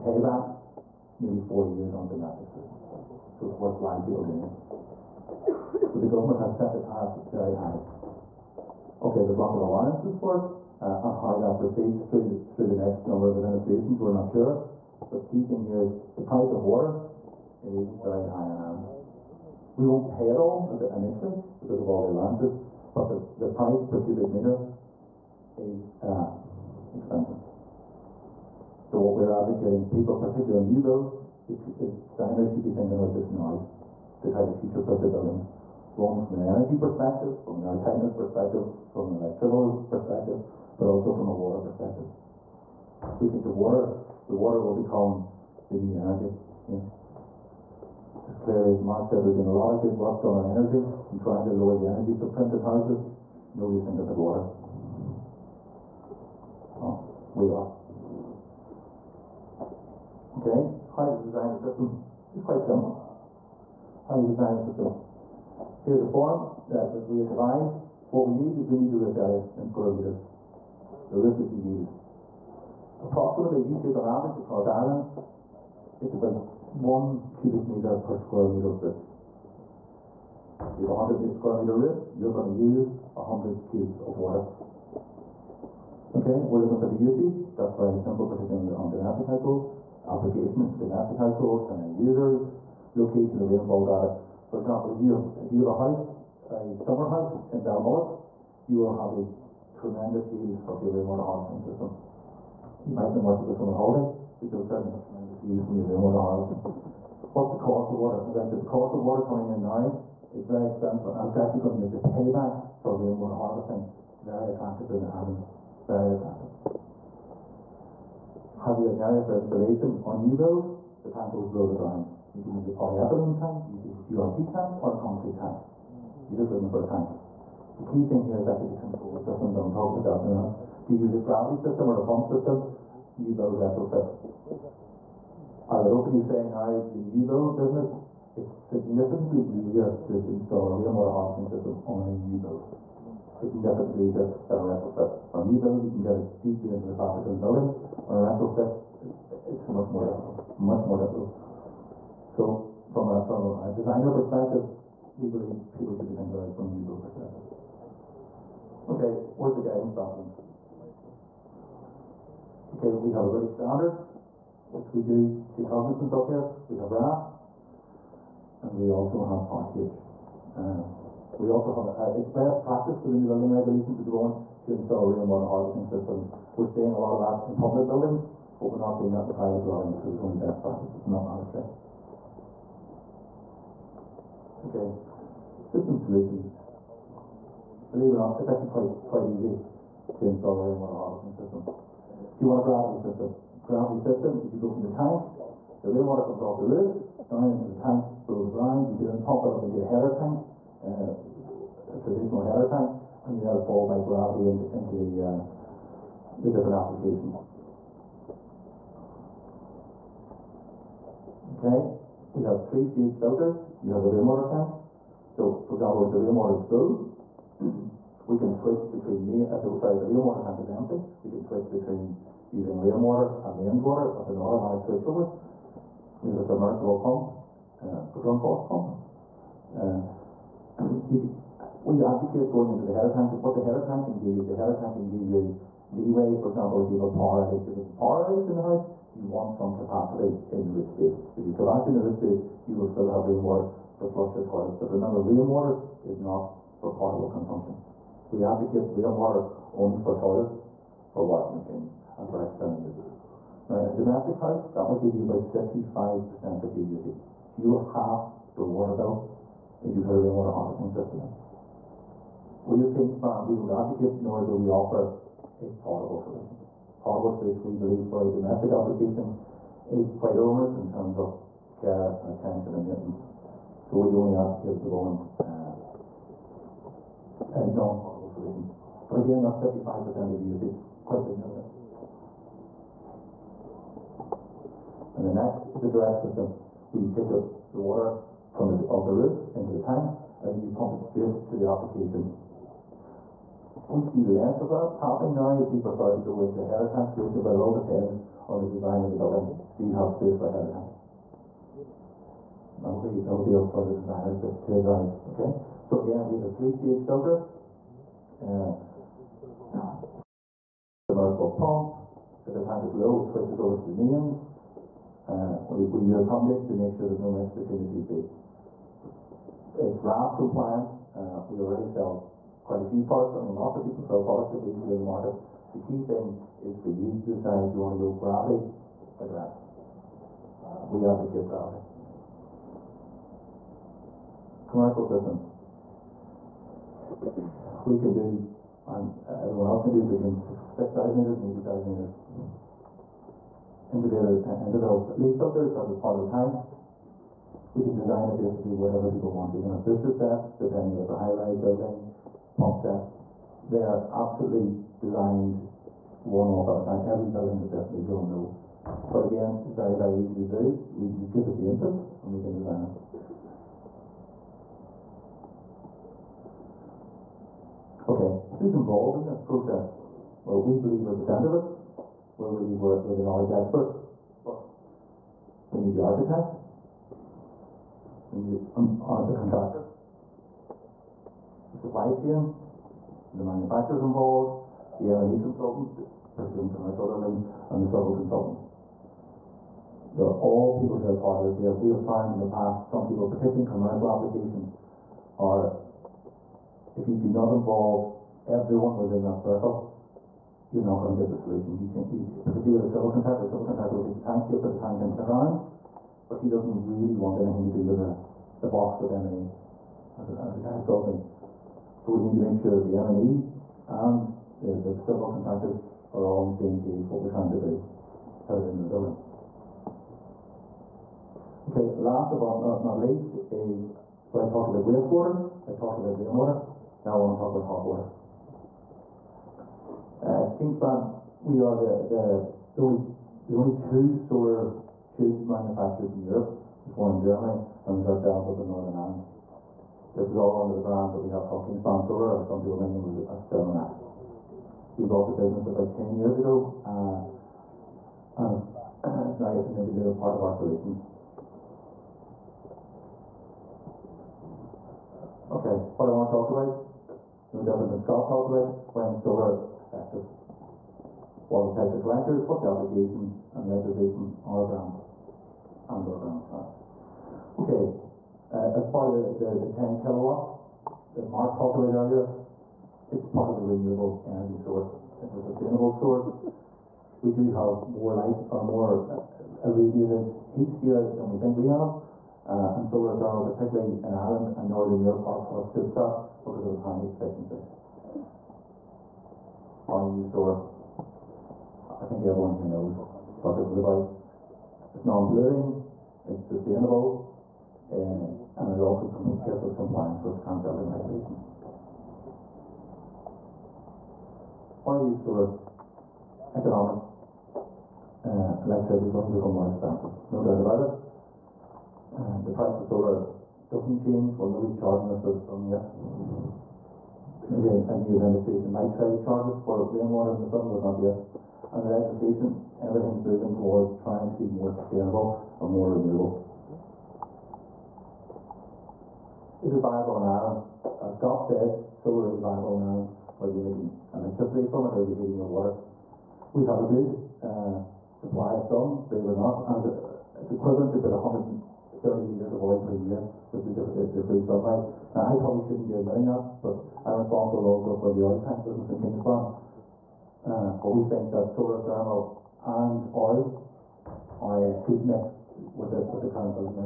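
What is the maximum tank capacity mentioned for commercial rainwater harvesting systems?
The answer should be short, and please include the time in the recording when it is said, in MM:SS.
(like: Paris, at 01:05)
80,000 litres, at 05:41.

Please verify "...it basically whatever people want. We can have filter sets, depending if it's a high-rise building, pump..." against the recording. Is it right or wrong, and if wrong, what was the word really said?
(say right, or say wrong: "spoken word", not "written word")
wrong: "booster", not "filter".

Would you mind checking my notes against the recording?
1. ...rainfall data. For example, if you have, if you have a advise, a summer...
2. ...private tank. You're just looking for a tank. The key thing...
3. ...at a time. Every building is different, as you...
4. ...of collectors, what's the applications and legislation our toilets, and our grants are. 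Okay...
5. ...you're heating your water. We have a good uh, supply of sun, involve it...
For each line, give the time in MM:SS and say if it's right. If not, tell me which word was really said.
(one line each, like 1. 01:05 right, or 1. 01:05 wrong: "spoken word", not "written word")
1. 01:33 wrong: "house", not "advise"
2. 02:04 wrong: "concrete", not "private"
3. 05:56 right
4. 07:41 wrong: "grants", not "toilets"
5. 08:55 wrong: "believe", not "involve".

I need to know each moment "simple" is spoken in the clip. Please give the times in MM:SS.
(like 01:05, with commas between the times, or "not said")
01:02, 01:27.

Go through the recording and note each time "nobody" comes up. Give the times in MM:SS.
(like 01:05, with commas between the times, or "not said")
00:53, 08:34.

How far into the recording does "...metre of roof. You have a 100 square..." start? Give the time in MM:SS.
01:18.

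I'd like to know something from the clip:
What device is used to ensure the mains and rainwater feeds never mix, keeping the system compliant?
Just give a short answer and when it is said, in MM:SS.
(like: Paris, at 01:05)
A tundish, at 05:16.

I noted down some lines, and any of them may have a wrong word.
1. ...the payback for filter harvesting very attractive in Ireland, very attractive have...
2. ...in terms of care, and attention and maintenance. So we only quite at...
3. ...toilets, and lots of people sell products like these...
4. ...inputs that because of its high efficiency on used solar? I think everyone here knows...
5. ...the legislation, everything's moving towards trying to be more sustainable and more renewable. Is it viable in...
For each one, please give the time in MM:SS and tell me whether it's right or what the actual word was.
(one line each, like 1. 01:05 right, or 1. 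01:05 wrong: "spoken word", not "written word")
1. 01:52 wrong: "rainwater", not "filter"
2. 04:30 wrong: "advocate", not "quite"
3. 05:23 wrong: "products", not "toilets"
4. 08:05 wrong: "suits", not "inputs"
5. 08:41 right.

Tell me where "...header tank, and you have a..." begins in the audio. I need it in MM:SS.
03:22.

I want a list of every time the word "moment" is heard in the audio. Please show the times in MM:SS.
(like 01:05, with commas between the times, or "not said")
02:54, 04:34.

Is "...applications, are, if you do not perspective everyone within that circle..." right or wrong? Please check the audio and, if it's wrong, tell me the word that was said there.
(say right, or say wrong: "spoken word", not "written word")
wrong: "involve", not "perspective".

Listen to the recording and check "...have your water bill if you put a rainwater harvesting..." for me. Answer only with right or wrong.
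right.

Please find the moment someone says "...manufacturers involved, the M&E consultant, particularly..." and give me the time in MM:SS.
06:23.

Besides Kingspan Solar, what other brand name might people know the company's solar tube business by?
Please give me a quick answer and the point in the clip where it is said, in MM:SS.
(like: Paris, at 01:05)
Thermax, at 07:23.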